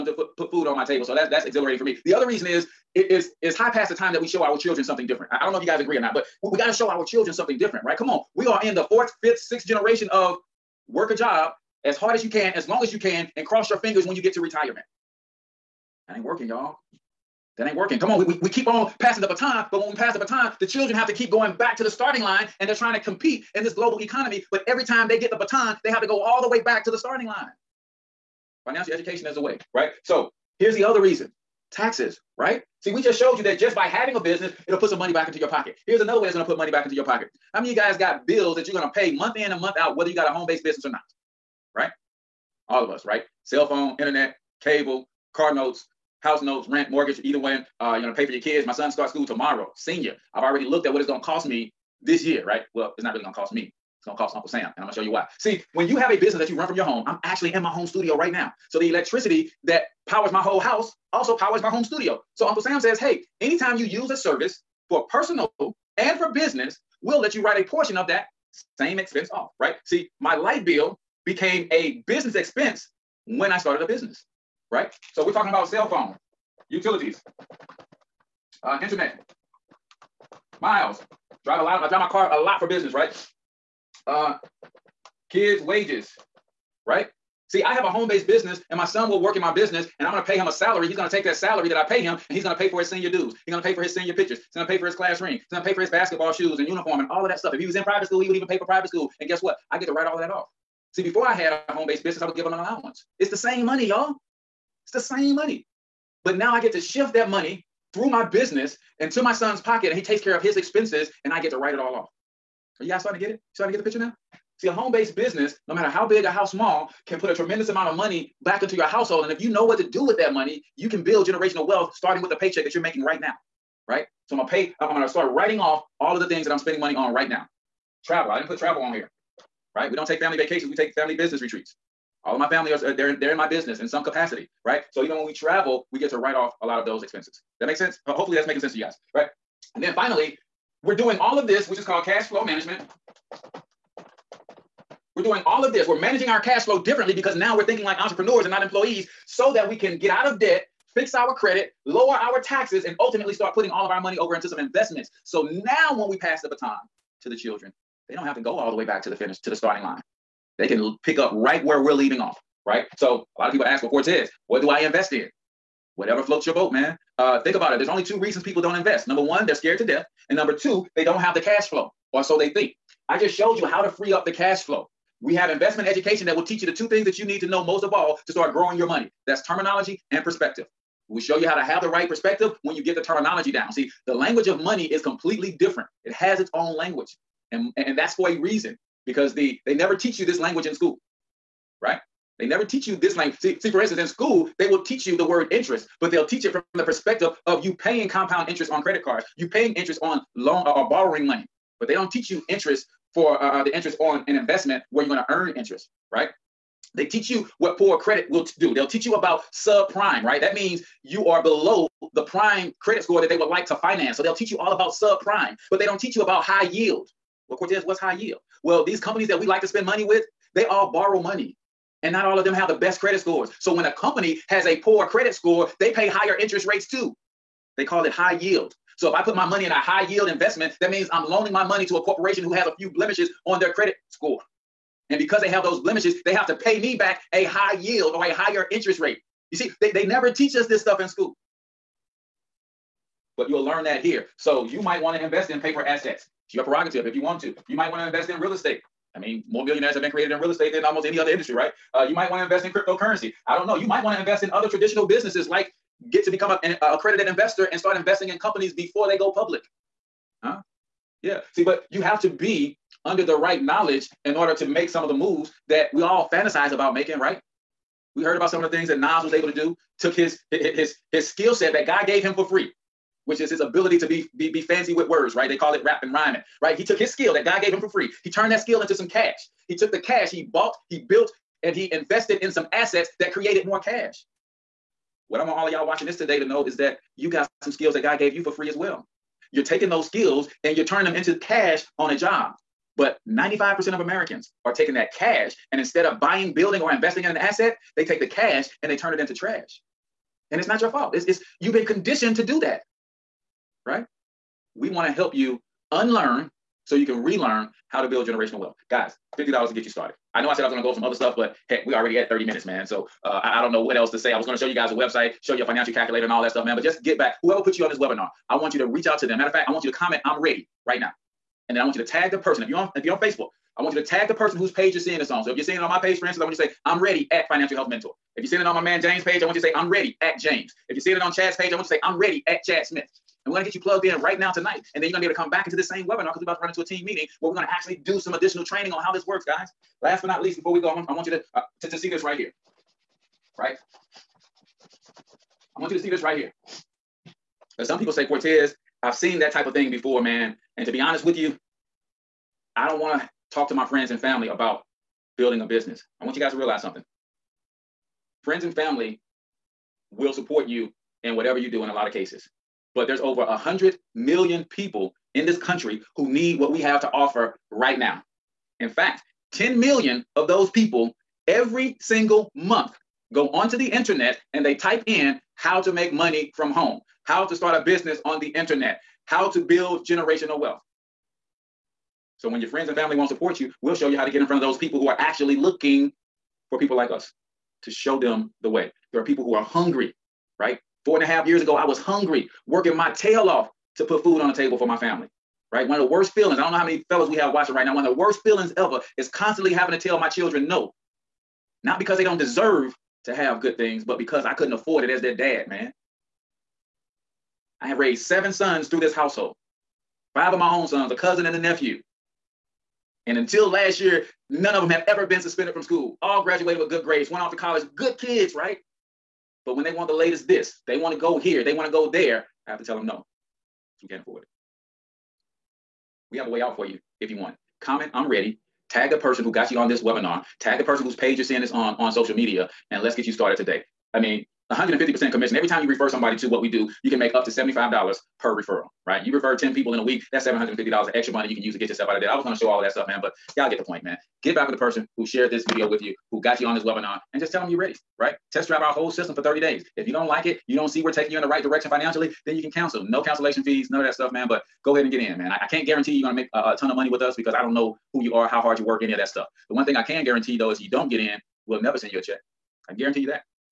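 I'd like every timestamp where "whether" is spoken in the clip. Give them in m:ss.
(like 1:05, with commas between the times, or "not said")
0:39.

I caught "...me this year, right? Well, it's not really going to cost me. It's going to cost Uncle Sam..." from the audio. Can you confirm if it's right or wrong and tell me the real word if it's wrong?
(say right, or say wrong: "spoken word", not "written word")
right.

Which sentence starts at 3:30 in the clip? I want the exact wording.
That means you are below the prime credit score that they would like to finance.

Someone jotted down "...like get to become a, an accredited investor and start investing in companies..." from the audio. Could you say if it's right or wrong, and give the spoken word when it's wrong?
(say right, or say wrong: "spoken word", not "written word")
right.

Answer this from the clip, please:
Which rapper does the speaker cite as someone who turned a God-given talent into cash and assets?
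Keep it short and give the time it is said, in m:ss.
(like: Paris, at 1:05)
Nas, at 4:28.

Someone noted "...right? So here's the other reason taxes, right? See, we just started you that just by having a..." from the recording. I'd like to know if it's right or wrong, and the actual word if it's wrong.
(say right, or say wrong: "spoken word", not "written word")
wrong: "showed", not "started".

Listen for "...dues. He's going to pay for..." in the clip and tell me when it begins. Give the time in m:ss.
1:33.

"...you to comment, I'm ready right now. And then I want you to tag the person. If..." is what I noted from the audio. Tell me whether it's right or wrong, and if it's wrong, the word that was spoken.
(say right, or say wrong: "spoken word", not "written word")
right.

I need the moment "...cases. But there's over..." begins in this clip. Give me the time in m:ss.
6:02.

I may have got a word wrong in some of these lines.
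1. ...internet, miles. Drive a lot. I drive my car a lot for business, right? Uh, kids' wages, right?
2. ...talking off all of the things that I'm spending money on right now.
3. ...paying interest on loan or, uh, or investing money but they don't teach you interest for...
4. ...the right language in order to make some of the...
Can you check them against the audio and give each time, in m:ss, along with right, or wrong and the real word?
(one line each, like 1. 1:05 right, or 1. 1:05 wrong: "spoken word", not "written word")
1. 1:18 right
2. 2:05 wrong: "writing", not "talking"
3. 3:19 wrong: "borrowing", not "investing"
4. 4:23 wrong: "knowledge", not "language".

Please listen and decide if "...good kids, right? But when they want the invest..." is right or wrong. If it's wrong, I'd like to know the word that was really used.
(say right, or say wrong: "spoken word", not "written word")
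wrong: "latest", not "invest".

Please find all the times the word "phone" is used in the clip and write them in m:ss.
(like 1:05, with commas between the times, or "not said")
0:43, 1:15.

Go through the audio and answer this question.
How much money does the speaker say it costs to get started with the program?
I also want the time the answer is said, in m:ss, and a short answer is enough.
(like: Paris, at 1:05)
$50, at 5:09.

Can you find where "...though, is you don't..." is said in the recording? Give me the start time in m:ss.
7:40.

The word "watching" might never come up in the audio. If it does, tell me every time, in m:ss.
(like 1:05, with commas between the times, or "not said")
4:45, 6:37.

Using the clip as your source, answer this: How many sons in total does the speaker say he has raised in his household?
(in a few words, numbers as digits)
7.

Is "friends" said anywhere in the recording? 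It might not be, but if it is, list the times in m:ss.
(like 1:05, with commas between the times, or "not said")
5:53, 5:58, 6:22.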